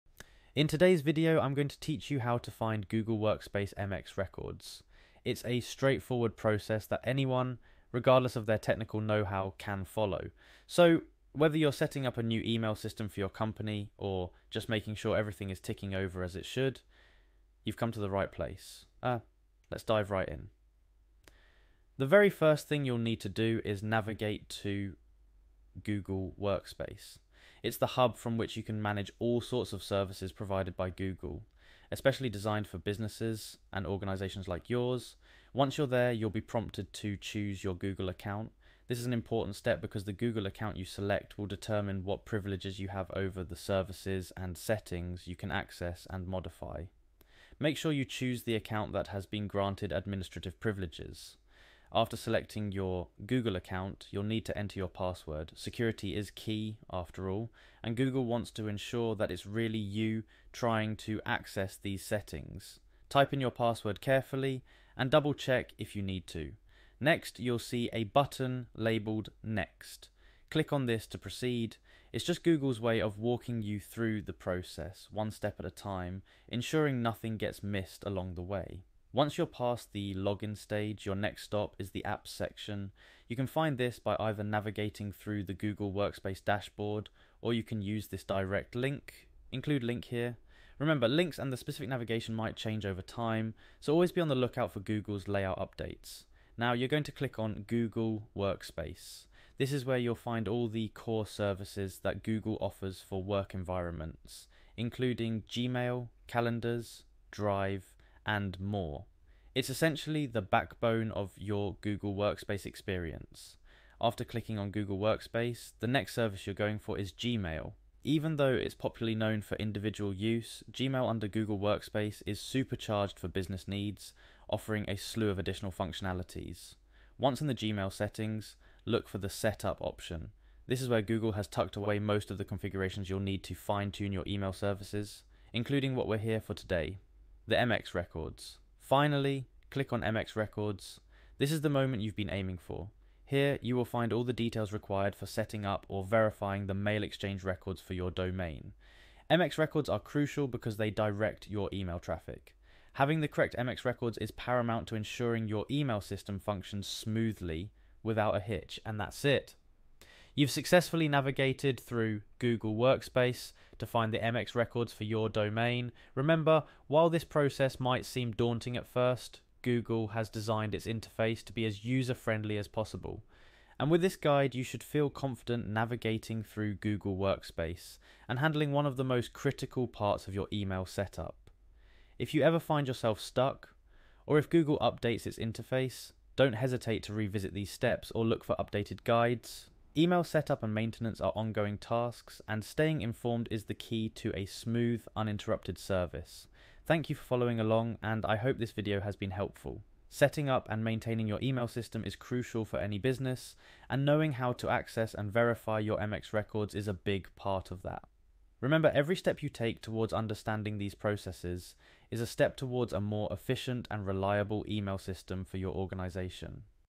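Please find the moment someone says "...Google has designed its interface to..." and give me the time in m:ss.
2:49.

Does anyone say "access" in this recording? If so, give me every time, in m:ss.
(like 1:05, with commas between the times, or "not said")
0:45, 1:01, 3:24.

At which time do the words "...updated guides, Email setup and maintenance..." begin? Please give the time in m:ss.
3:08.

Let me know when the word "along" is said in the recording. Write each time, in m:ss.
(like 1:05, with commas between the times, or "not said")
1:18, 3:17.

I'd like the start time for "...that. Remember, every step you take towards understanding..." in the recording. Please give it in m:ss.
3:27.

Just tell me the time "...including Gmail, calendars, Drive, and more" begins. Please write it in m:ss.
1:44.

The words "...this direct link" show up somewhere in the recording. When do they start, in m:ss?
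1:28.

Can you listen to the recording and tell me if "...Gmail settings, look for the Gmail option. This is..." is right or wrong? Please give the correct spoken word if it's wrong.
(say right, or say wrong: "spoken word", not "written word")
wrong: "Setup", not "Gmail".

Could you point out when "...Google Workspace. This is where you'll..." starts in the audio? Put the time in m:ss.
1:37.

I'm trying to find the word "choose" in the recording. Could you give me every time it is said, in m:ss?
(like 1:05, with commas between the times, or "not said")
0:37, 0:48.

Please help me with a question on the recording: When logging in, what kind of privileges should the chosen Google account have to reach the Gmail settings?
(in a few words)
Administrative privileges.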